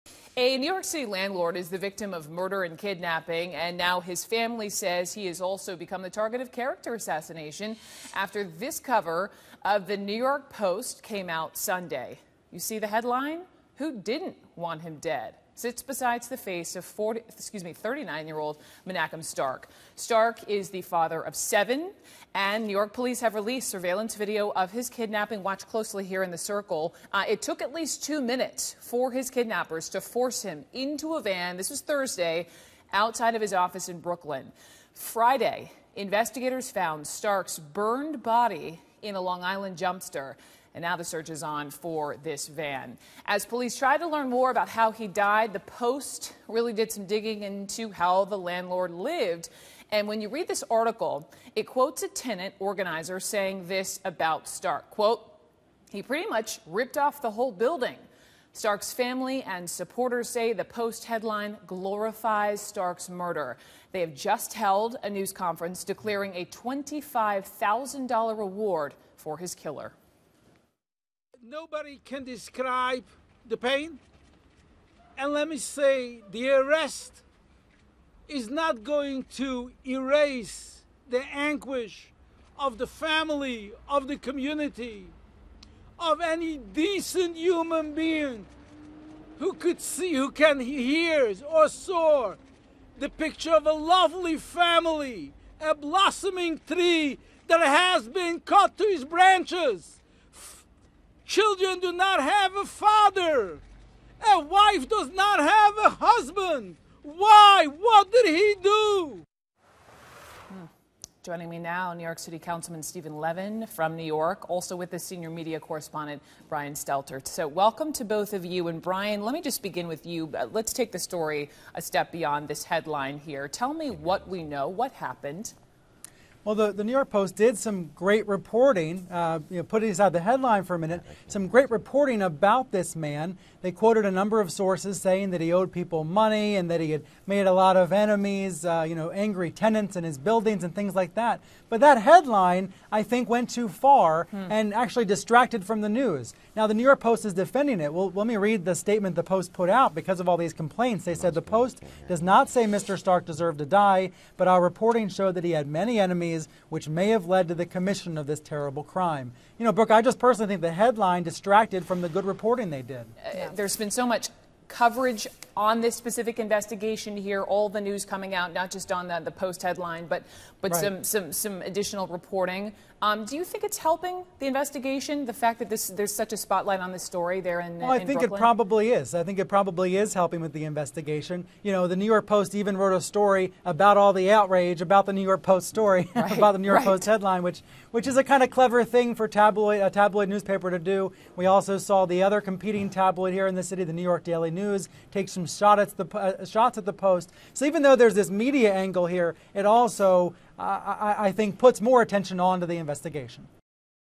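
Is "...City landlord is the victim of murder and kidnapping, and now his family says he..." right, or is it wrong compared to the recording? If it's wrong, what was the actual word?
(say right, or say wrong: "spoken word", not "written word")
right.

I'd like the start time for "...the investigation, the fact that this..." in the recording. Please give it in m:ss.
2:54.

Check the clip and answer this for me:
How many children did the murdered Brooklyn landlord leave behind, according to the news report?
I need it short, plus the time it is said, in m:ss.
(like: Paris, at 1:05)
7, at 0:21.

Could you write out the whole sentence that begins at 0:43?
As police try to learn more about how he died, the Post really did some digging into how the landlord lived.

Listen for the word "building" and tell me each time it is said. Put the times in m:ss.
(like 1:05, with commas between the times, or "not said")
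0:57, 2:20.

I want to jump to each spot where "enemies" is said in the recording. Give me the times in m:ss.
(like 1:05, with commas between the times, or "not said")
2:17, 2:35.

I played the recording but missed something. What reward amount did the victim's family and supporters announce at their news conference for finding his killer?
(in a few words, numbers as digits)
$25,000.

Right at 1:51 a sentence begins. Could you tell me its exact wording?
Joining me now, New York City Councilman Stephen Levin from New York, also with the senior media correspondent Brian Stelter.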